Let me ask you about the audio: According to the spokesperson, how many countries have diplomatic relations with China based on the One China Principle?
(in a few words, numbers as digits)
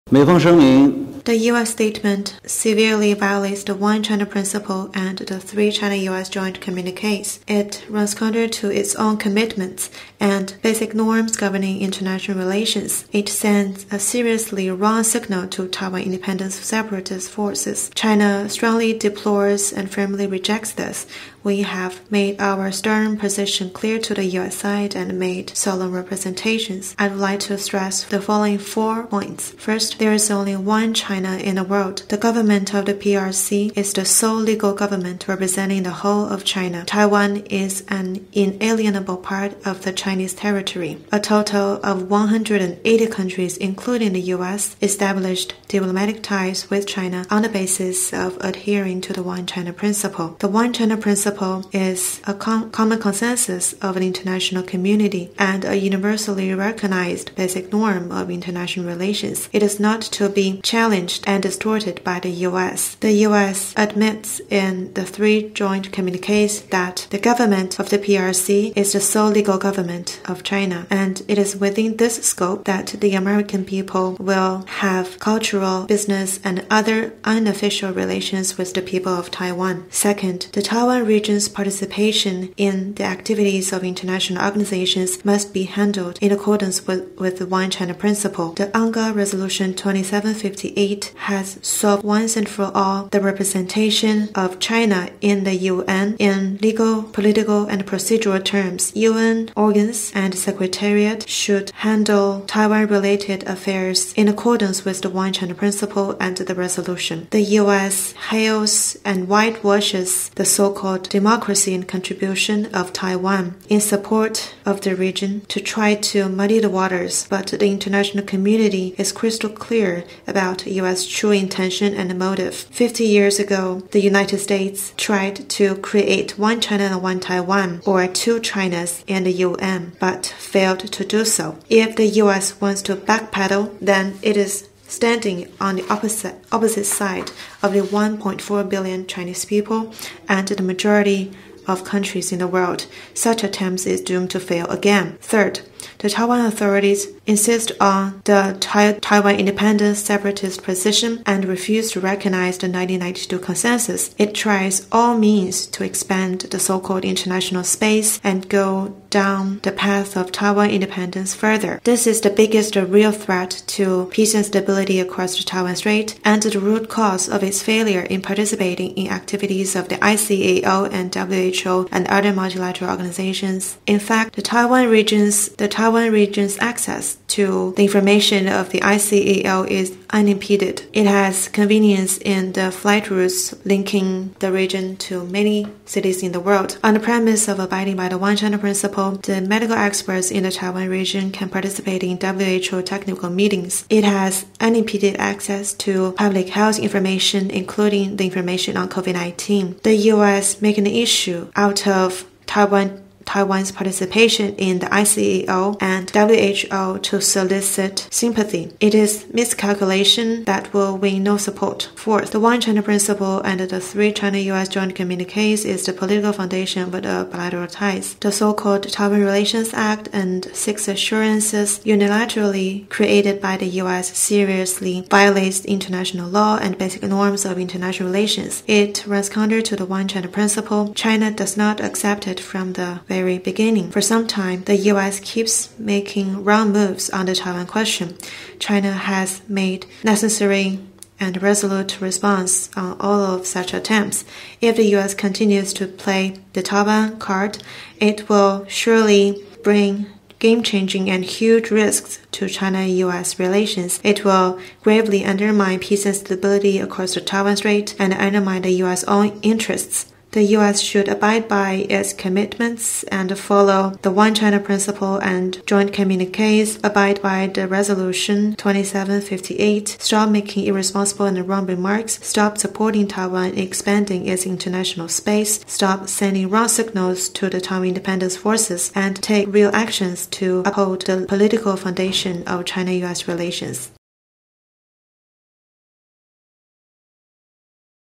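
180.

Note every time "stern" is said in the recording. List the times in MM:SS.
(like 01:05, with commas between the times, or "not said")
00:22.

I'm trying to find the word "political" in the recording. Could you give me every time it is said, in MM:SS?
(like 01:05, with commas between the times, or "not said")
01:37, 03:35, 04:41.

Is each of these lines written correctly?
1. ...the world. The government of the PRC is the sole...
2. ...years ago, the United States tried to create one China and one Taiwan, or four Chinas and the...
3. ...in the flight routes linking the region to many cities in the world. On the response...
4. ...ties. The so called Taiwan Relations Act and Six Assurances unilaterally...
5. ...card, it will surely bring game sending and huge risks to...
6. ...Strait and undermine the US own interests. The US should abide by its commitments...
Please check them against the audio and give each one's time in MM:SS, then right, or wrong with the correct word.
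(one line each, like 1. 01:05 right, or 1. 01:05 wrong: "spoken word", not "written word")
1. 00:31 right
2. 02:03 wrong: "two", not "four"
3. 03:02 wrong: "premise", not "response"
4. 03:37 right
5. 04:07 wrong: "changing", not "sending"
6. 04:17 right.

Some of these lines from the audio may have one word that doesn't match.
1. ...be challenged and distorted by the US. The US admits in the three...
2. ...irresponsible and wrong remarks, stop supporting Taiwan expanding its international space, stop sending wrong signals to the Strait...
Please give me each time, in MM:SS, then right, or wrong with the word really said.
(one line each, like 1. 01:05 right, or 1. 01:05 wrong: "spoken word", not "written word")
1. 01:00 right
2. 04:30 wrong: "Taiwan", not "Strait".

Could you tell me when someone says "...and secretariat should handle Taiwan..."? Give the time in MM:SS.
01:40.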